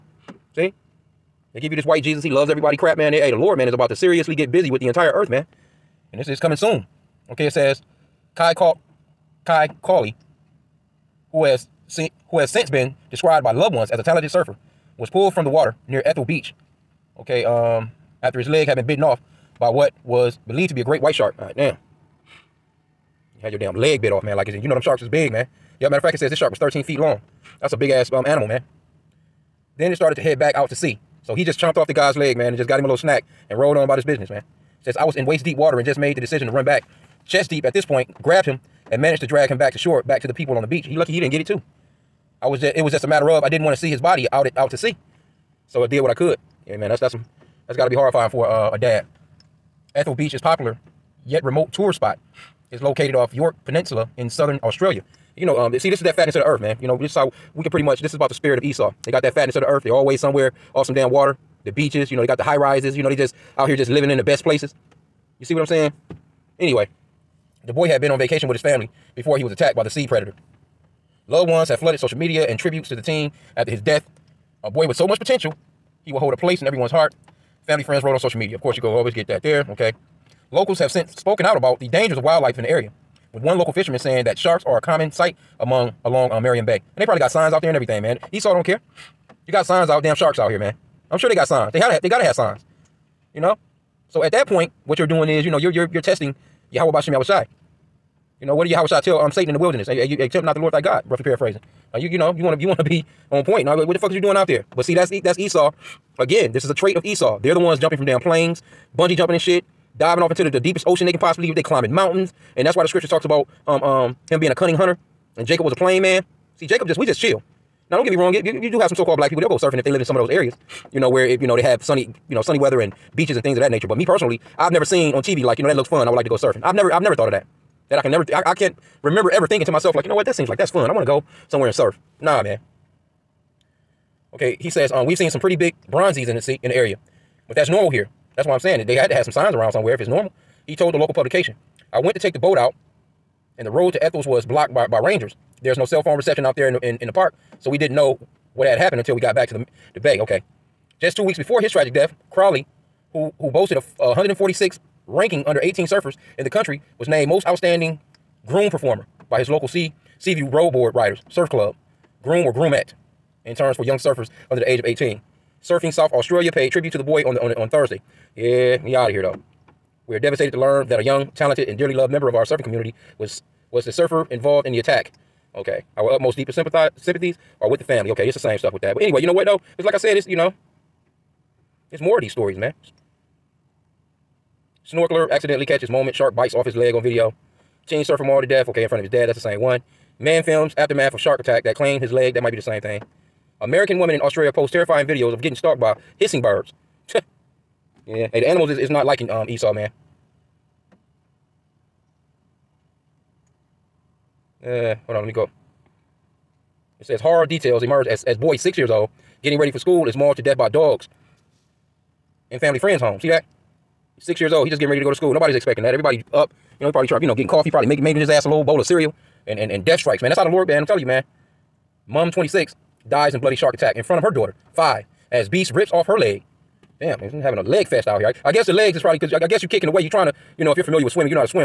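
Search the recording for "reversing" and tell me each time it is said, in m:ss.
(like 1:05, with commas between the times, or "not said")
not said.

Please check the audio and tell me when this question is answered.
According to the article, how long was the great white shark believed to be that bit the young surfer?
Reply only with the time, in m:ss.
0:26.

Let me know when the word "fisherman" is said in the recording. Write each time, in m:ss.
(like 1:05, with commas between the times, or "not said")
1:23.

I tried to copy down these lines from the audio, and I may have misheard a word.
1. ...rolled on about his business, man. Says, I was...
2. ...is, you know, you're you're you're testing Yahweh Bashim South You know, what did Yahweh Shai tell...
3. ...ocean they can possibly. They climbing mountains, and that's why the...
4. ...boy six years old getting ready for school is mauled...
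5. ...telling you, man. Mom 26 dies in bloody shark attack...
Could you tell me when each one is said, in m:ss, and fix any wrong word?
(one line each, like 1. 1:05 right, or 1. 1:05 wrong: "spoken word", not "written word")
1. 0:33 right
2. 1:35 wrong: "Yahweh", not "South"
3. 1:50 right
4. 3:28 right
5. 3:40 right.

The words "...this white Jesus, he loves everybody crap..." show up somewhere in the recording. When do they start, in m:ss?
0:01.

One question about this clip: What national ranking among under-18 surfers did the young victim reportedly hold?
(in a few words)
146.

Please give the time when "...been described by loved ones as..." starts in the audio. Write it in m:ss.
0:12.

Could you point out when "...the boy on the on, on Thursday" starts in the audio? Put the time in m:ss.
2:46.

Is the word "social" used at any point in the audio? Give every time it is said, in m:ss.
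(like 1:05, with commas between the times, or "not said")
1:11, 1:18.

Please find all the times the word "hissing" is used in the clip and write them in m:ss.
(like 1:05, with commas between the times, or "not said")
3:16.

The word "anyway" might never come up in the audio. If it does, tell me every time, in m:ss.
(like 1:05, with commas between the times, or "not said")
1:06, 2:59.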